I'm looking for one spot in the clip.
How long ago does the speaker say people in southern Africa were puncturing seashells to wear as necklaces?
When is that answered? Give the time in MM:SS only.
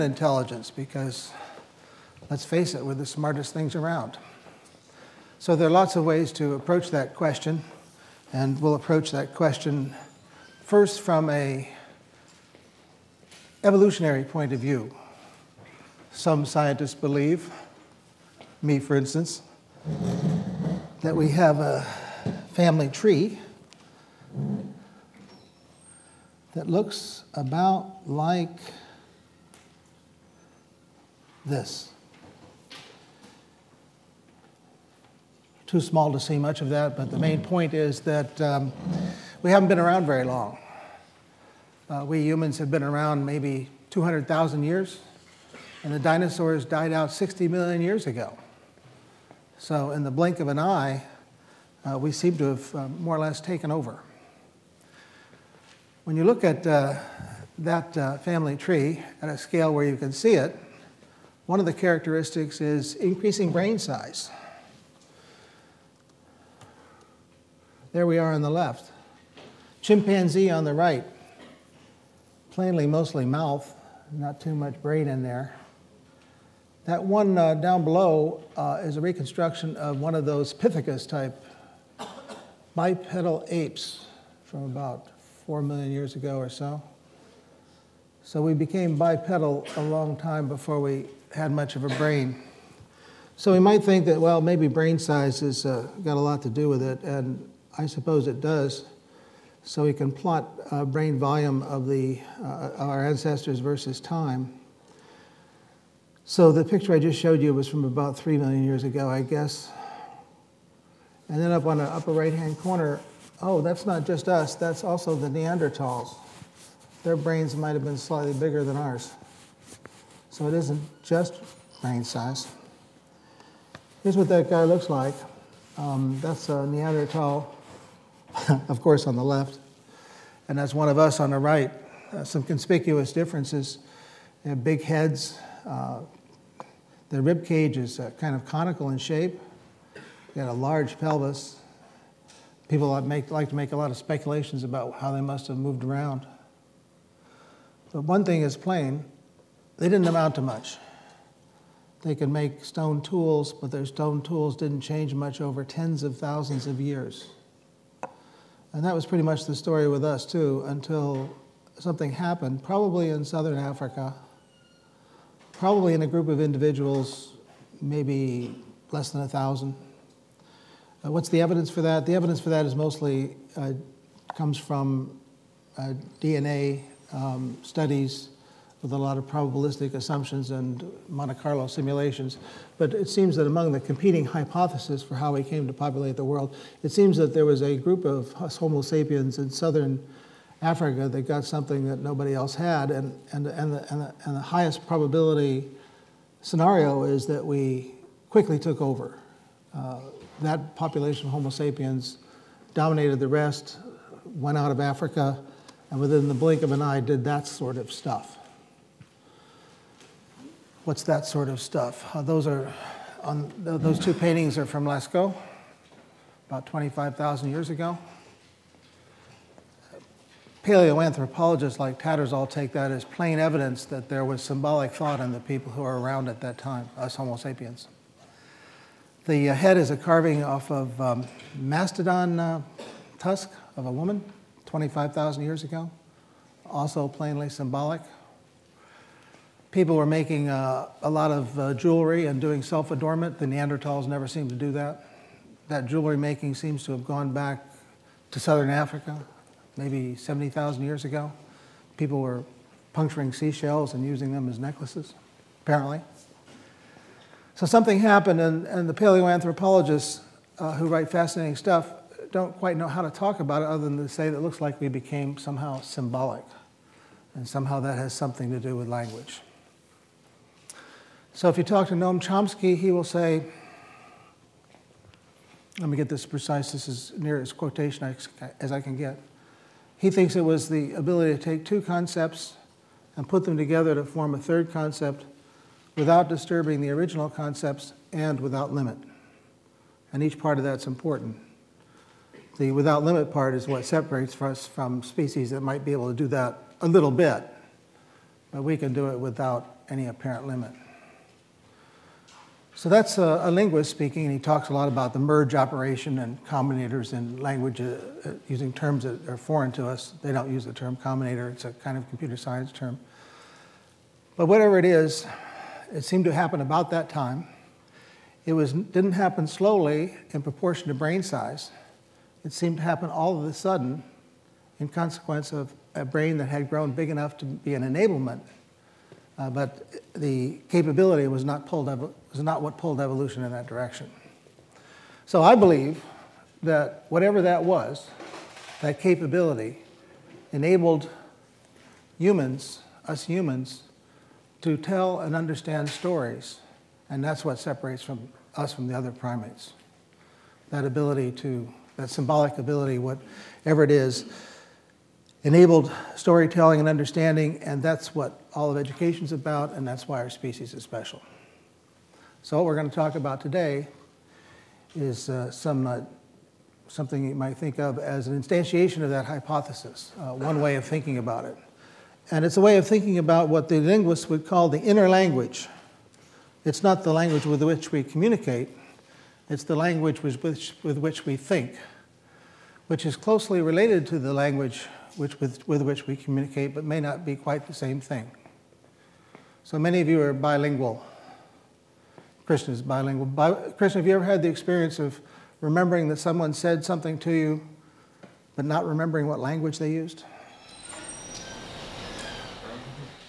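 04:10.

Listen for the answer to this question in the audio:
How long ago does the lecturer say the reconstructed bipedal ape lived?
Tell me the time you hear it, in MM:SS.
01:25.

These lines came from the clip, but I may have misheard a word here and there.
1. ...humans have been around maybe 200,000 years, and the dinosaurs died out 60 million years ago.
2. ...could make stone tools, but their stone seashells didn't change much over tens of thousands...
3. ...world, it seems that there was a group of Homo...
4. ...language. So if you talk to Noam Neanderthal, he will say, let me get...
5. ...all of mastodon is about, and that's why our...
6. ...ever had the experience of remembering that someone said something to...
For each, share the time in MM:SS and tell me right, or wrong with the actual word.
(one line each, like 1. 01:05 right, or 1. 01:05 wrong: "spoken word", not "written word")
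1. 00:42 right
2. 02:32 wrong: "tools", not "seashells"
3. 03:06 right
4. 04:28 wrong: "Chomsky", not "Neanderthal"
5. 05:58 wrong: "education", not "mastodon"
6. 06:34 right.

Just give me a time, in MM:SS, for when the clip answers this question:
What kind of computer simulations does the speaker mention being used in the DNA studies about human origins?
03:01.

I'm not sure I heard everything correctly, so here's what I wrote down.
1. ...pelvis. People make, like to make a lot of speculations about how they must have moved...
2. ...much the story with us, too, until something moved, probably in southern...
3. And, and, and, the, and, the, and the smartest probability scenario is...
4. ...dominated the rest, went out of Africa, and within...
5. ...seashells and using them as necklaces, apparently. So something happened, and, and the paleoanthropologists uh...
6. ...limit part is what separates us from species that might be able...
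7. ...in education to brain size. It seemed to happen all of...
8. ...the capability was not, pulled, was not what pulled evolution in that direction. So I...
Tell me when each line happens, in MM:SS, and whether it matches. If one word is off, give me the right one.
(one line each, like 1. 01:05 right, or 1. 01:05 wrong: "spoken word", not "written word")
1. 02:20 right
2. 02:39 wrong: "happened", not "moved"
3. 03:12 wrong: "highest", not "smartest"
4. 03:22 right
5. 04:13 right
6. 04:53 right
7. 05:20 wrong: "proportion", not "education"
8. 05:30 right.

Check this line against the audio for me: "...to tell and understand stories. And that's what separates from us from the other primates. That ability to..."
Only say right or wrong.
right.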